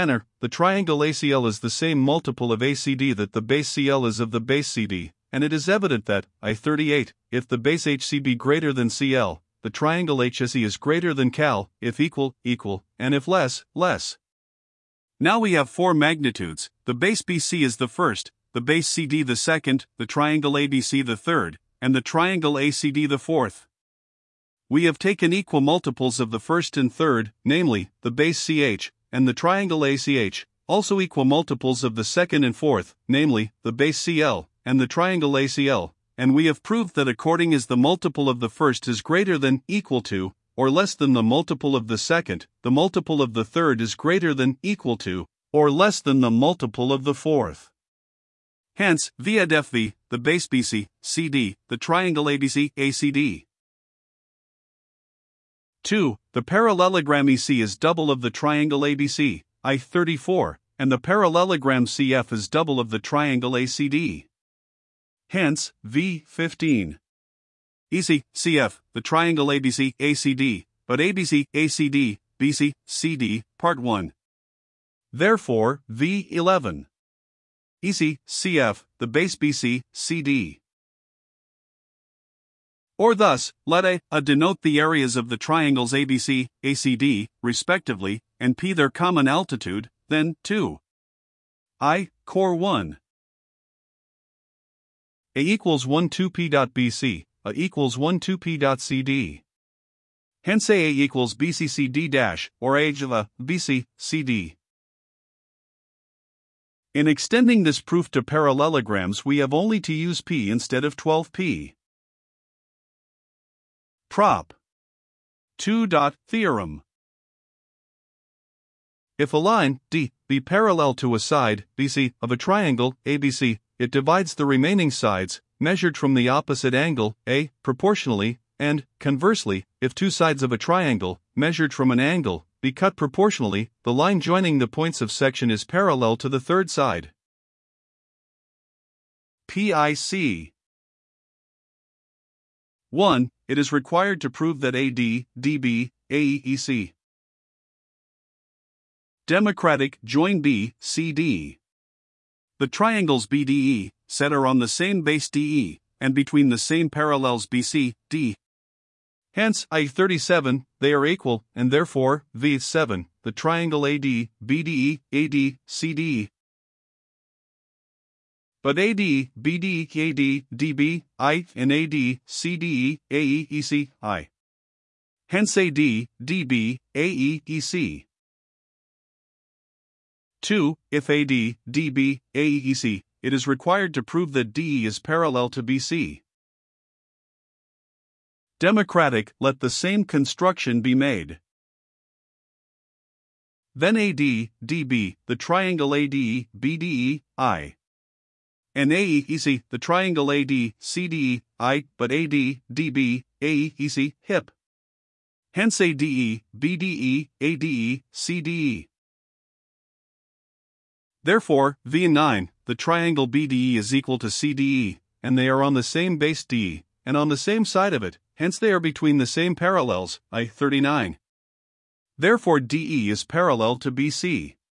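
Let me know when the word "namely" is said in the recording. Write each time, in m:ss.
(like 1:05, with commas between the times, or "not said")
0:27, 0:33.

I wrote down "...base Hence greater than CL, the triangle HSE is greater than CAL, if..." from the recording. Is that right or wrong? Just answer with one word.
wrong.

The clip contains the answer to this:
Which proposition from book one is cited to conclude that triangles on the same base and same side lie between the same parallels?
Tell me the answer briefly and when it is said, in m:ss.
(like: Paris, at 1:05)
I 39, at 3:40.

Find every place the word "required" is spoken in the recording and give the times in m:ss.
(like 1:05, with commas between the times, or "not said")
2:23, 3:03.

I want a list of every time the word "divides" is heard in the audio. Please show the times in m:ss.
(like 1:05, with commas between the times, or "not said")
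2:03.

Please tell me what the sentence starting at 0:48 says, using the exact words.
Hence, via the base BC, CD, the triangle ABC, ACD.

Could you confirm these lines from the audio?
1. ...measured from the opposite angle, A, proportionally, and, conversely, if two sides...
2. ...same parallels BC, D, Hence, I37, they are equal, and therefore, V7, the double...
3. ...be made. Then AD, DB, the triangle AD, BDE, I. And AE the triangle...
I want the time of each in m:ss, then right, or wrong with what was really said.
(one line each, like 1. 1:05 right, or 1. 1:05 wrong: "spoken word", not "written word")
1. 2:05 right
2. 2:36 wrong: "triangle", not "double"
3. 3:10 right.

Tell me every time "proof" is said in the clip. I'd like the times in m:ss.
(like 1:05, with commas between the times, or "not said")
1:47.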